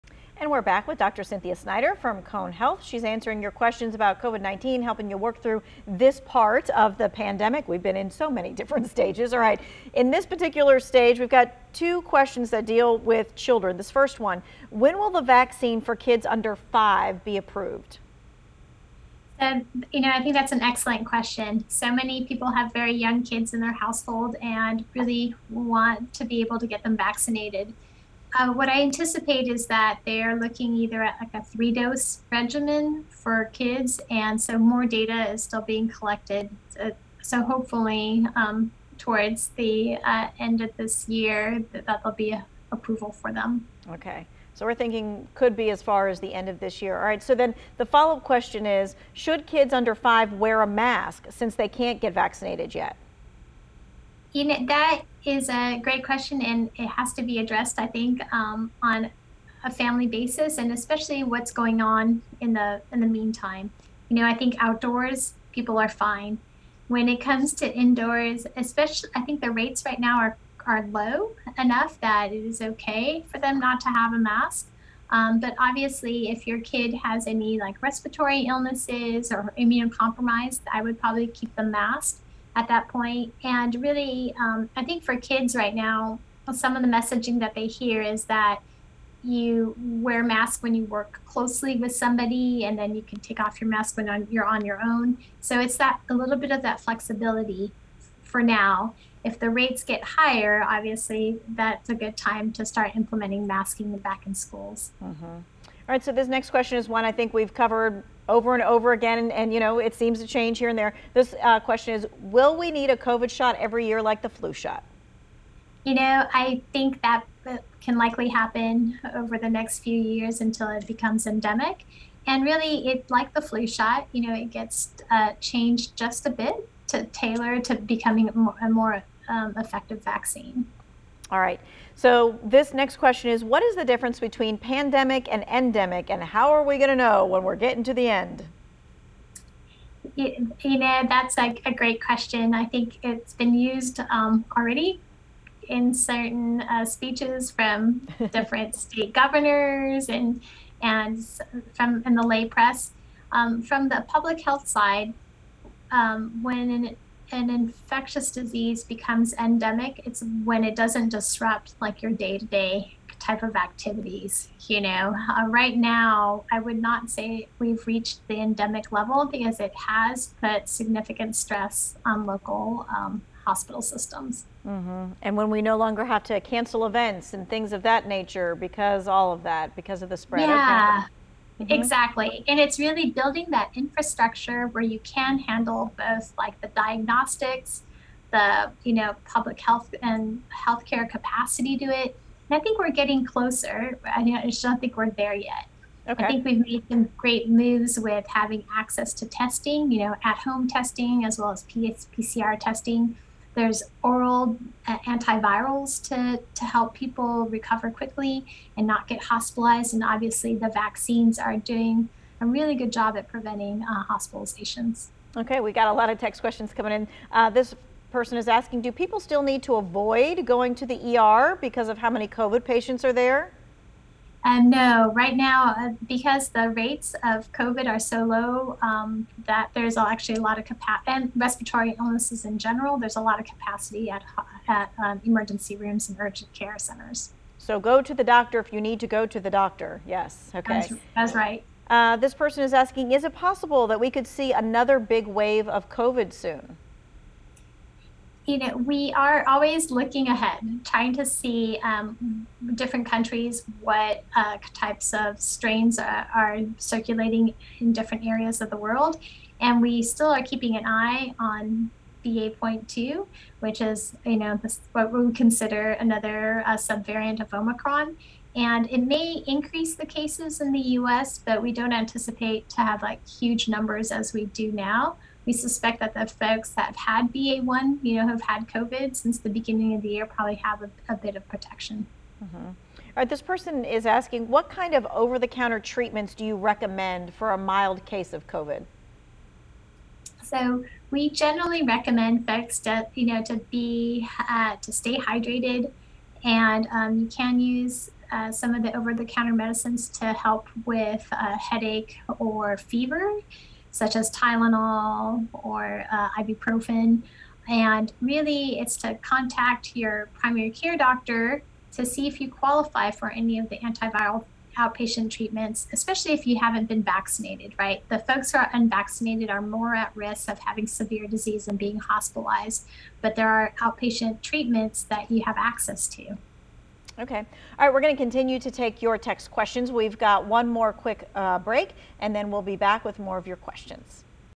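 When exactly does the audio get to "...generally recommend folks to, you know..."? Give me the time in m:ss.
4:51.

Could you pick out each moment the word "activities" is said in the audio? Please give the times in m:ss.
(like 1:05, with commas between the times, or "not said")
2:43.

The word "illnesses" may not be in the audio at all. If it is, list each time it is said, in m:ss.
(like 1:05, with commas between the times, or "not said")
1:18, 3:51.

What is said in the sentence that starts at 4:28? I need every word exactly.
And it may increase the cases in the US, but we don't anticipate to have like huge numbers as we do now.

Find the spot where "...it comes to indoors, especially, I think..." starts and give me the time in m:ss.
1:07.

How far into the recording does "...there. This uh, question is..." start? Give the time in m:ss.
1:50.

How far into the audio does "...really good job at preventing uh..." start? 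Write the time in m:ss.
3:32.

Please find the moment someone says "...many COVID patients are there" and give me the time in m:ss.
3:42.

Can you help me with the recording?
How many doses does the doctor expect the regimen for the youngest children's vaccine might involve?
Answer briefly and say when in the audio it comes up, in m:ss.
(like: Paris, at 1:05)
3, at 0:31.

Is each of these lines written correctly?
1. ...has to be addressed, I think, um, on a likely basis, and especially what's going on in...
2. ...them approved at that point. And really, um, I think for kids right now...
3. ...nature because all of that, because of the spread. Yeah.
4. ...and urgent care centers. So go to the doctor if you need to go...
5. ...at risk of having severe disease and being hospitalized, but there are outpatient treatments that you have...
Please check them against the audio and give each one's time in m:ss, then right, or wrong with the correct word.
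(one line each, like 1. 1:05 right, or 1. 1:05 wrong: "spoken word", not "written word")
1. 0:56 wrong: "family", not "likely"
2. 1:21 wrong: "masked", not "approved"
3. 2:58 right
4. 3:56 right
5. 5:19 right.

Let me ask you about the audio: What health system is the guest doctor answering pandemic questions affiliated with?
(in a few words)
Cone Health.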